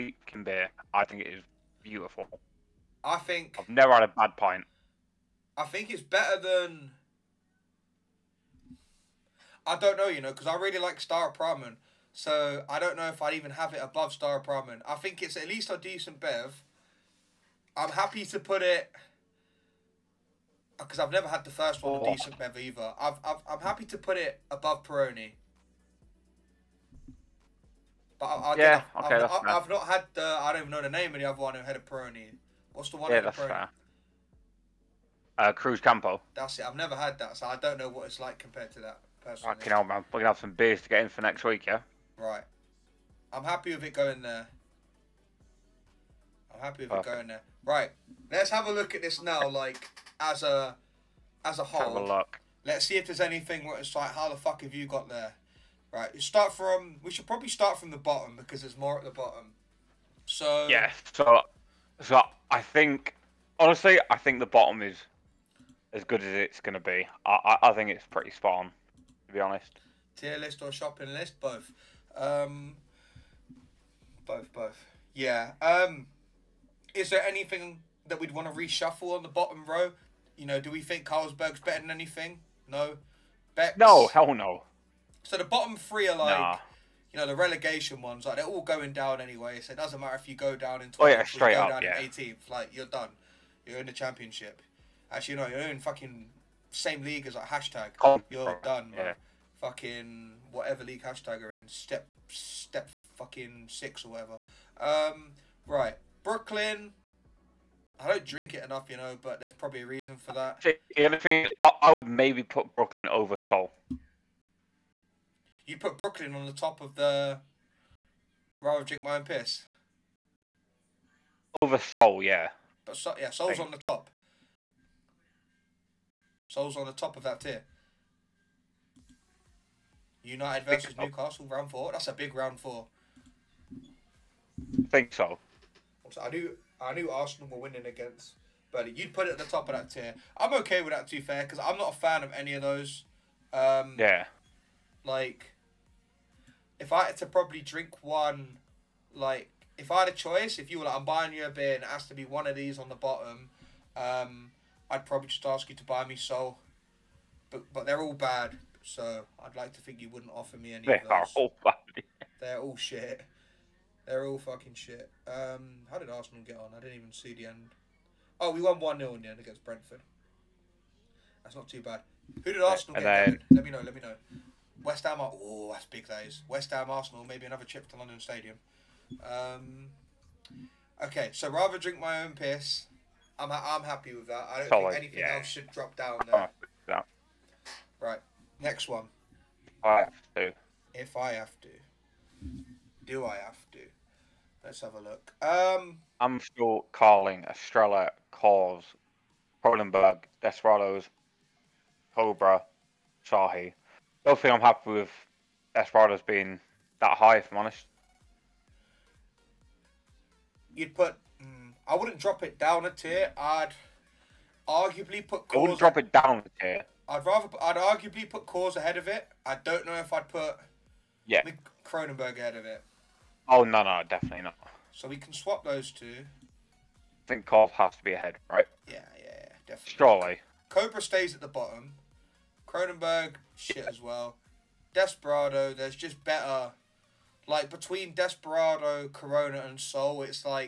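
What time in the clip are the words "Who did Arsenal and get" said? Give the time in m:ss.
2:52.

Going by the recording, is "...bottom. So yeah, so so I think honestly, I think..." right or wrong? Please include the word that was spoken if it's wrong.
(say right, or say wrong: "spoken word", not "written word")
right.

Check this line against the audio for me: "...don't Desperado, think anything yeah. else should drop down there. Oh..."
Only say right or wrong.
wrong.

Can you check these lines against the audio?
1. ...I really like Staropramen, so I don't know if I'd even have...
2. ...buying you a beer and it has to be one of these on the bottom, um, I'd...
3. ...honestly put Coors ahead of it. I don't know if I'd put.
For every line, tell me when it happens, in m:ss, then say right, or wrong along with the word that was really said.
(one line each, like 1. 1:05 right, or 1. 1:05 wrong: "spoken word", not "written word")
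1. 0:10 right
2. 2:31 right
3. 3:37 wrong: "arguably", not "honestly".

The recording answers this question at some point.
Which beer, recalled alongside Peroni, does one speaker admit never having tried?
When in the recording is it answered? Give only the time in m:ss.
0:35.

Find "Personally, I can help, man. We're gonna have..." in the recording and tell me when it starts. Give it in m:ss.
0:39.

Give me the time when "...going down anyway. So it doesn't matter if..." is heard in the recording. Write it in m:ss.
1:28.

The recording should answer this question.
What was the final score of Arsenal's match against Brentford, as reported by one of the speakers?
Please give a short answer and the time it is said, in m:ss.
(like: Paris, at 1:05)
1-0, at 2:48.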